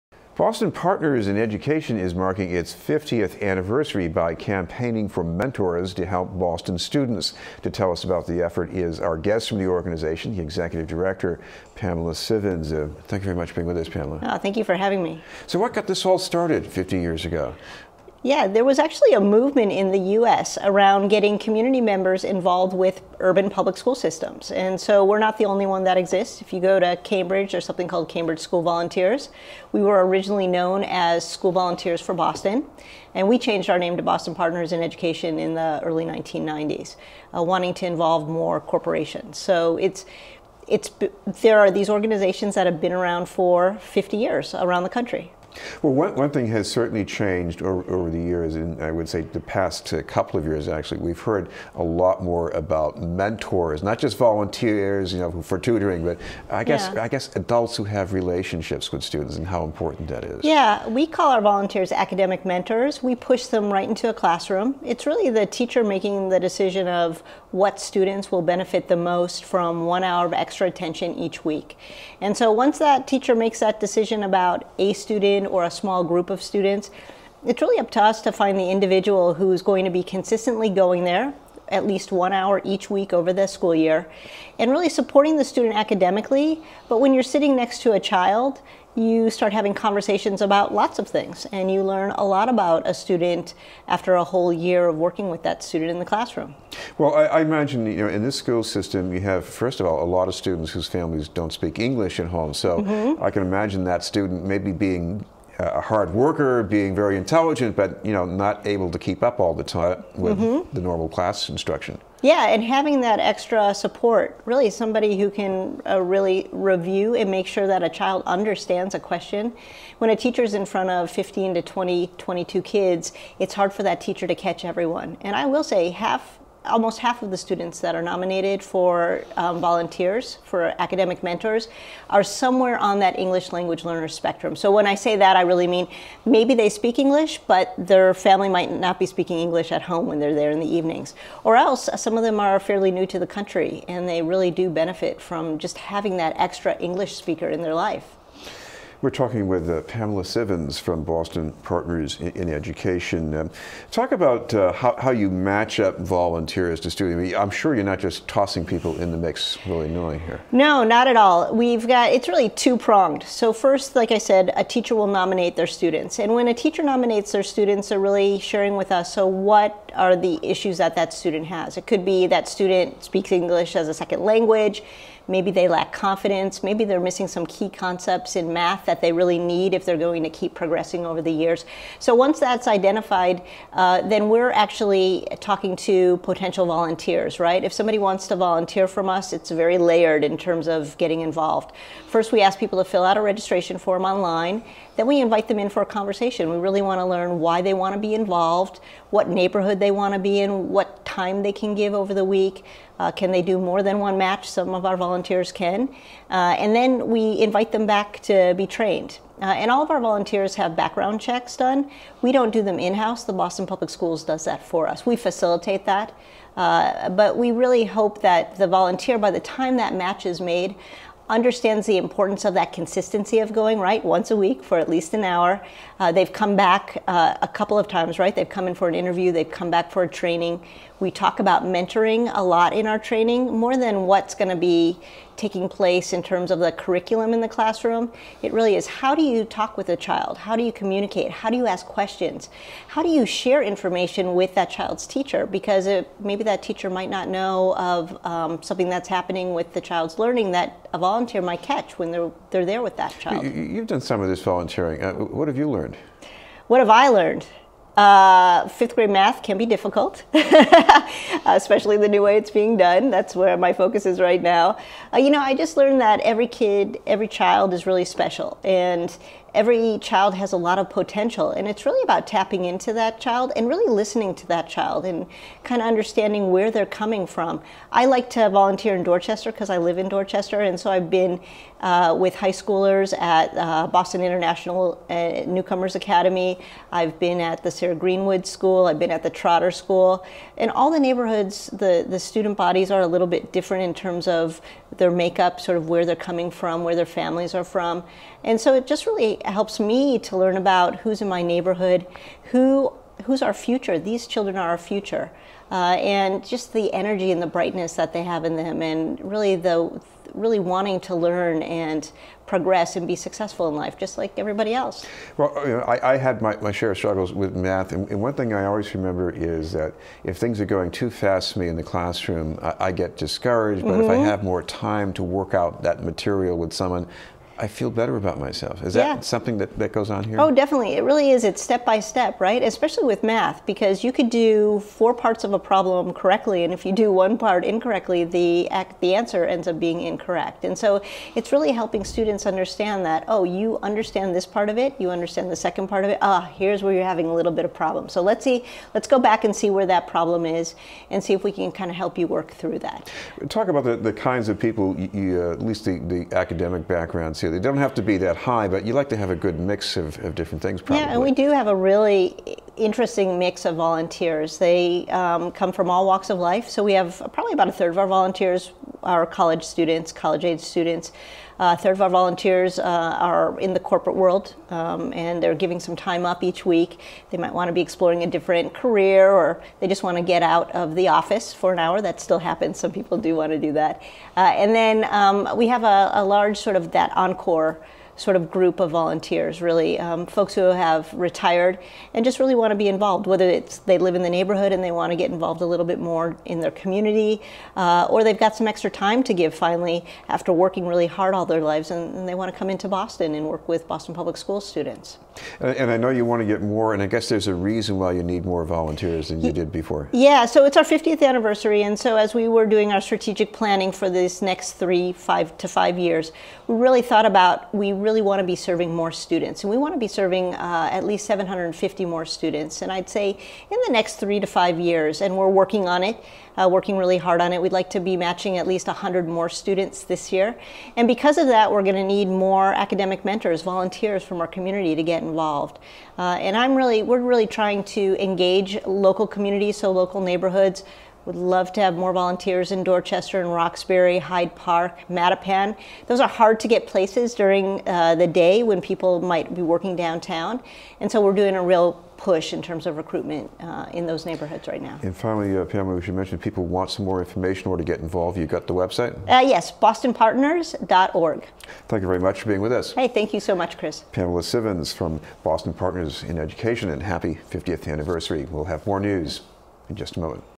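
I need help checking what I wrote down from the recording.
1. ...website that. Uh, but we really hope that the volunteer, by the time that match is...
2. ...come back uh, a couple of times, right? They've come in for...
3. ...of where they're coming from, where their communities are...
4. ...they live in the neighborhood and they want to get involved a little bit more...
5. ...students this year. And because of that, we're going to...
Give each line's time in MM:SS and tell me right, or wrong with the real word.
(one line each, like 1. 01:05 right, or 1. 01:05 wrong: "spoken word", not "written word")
1. 03:35 wrong: "facilitate", not "website"
2. 03:46 right
3. 04:55 wrong: "families", not "communities"
4. 06:33 right
5. 07:09 right.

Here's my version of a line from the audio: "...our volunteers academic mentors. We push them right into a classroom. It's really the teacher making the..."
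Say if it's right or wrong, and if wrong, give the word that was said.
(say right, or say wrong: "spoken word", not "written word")
right.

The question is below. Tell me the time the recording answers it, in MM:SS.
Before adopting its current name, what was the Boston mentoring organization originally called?
00:31.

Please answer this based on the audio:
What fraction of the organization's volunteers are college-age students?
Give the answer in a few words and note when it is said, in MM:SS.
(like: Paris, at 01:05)
a third, at 06:07.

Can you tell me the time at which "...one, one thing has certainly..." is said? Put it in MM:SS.
00:45.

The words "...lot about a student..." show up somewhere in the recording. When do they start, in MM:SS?
01:32.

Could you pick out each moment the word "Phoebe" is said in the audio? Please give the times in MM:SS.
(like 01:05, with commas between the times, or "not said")
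not said.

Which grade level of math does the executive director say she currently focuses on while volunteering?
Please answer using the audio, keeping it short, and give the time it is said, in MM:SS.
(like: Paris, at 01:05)
fifth grade, at 04:18.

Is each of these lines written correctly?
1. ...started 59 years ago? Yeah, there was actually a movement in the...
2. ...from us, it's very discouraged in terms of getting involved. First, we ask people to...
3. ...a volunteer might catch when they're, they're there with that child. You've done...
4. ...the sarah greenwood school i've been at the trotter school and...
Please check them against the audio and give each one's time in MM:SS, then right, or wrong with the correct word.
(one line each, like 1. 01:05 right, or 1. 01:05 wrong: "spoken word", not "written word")
1. 00:16 wrong: "50", not "59"
2. 03:08 wrong: "layered", not "discouraged"
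3. 04:10 right
4. 04:47 right.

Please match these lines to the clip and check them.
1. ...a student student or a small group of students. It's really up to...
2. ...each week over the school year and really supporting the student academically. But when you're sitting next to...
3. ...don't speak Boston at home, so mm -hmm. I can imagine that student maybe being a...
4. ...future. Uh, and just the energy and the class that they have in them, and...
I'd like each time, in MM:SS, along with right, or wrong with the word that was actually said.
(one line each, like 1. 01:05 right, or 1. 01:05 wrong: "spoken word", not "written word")
1. 01:14 right
2. 01:22 right
3. 01:41 wrong: "English", not "Boston"
4. 05:04 wrong: "brightness", not "class".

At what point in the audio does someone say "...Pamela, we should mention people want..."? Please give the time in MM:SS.
07:35.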